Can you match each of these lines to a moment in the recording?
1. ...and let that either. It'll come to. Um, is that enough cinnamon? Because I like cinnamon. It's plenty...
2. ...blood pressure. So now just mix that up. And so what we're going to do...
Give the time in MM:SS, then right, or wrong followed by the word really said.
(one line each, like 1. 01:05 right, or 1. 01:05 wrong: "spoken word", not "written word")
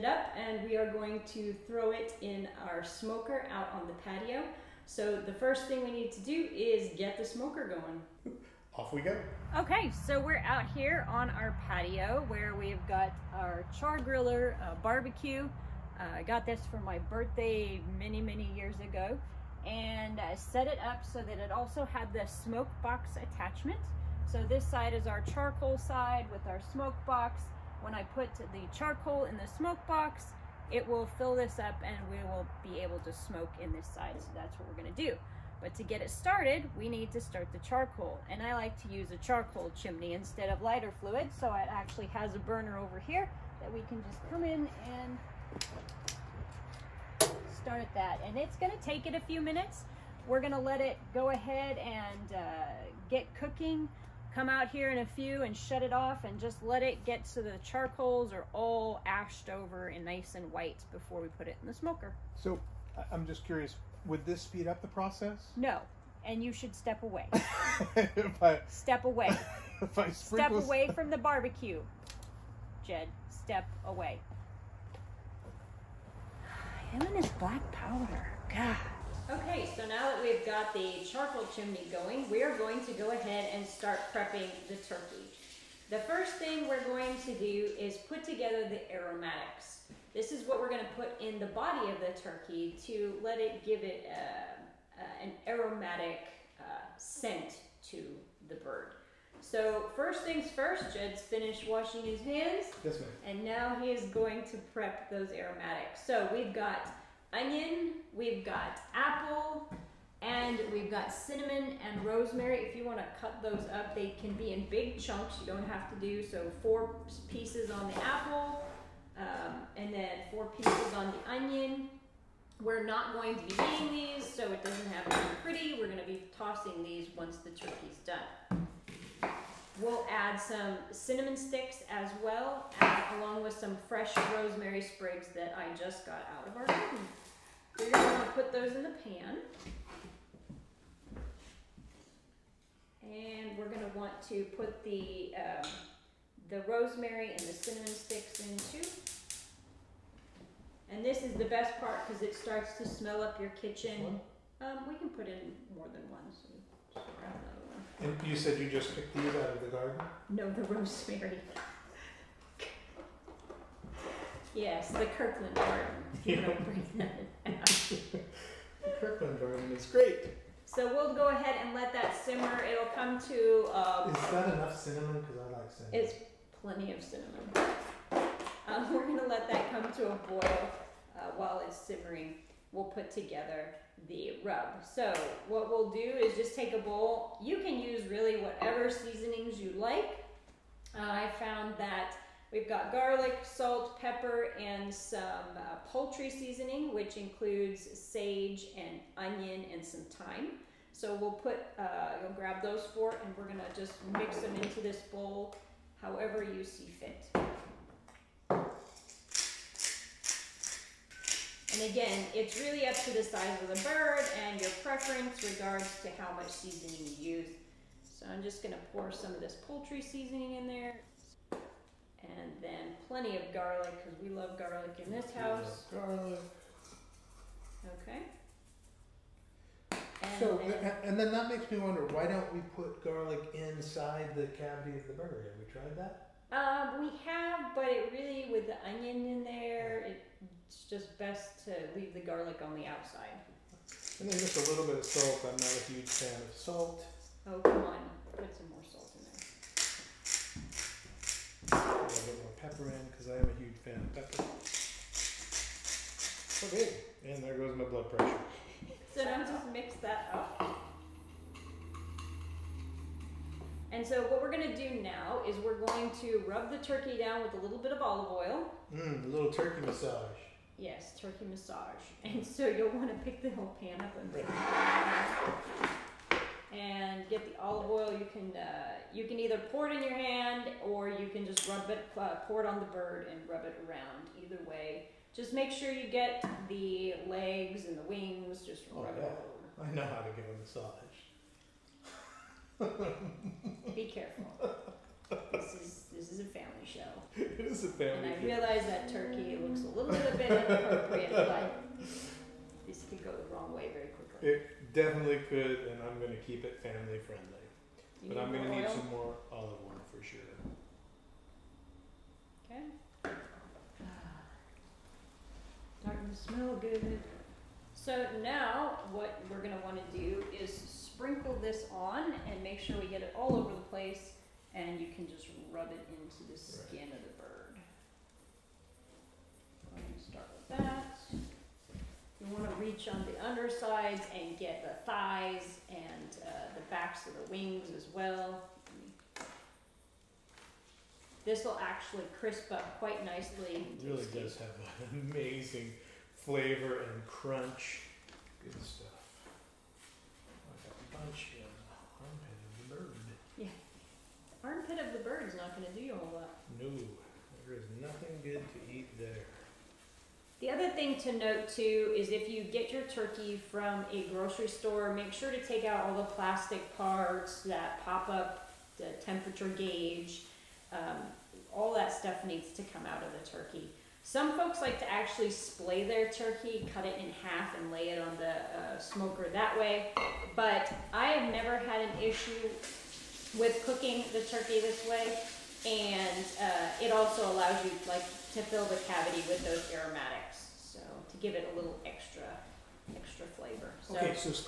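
1. 02:51 wrong: "simmer", not "either"
2. 04:17 right.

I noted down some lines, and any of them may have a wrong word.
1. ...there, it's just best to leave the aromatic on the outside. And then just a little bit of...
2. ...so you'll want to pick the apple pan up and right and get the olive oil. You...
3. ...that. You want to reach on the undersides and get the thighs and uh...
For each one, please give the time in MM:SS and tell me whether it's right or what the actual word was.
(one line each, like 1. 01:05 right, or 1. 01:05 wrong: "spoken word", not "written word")
1. 03:59 wrong: "garlic", not "aromatic"
2. 04:32 wrong: "whole", not "apple"
3. 05:30 right.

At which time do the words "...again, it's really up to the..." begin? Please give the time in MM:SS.
03:31.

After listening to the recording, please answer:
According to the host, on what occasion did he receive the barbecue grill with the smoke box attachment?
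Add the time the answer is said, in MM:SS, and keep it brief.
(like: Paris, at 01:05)
for my birthday, at 00:16.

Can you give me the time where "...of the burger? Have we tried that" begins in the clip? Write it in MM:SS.
03:54.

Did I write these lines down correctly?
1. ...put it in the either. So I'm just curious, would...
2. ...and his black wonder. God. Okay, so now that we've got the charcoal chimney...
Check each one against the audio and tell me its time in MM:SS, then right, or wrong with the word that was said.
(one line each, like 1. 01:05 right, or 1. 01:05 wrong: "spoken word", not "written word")
1. 01:01 wrong: "smoker", not "either"
2. 01:17 wrong: "powder", not "wonder".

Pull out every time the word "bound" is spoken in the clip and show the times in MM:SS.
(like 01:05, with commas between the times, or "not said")
not said.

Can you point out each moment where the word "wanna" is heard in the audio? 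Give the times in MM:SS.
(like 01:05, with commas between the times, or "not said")
02:18, 05:19.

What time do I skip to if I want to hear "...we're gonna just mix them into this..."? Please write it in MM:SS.
03:23.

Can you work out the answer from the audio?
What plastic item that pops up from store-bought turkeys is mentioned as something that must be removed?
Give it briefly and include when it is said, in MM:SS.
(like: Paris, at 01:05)
temperature gauge, at 06:09.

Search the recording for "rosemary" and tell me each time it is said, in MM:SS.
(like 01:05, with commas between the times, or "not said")
01:52, 02:14, 02:26, 02:40.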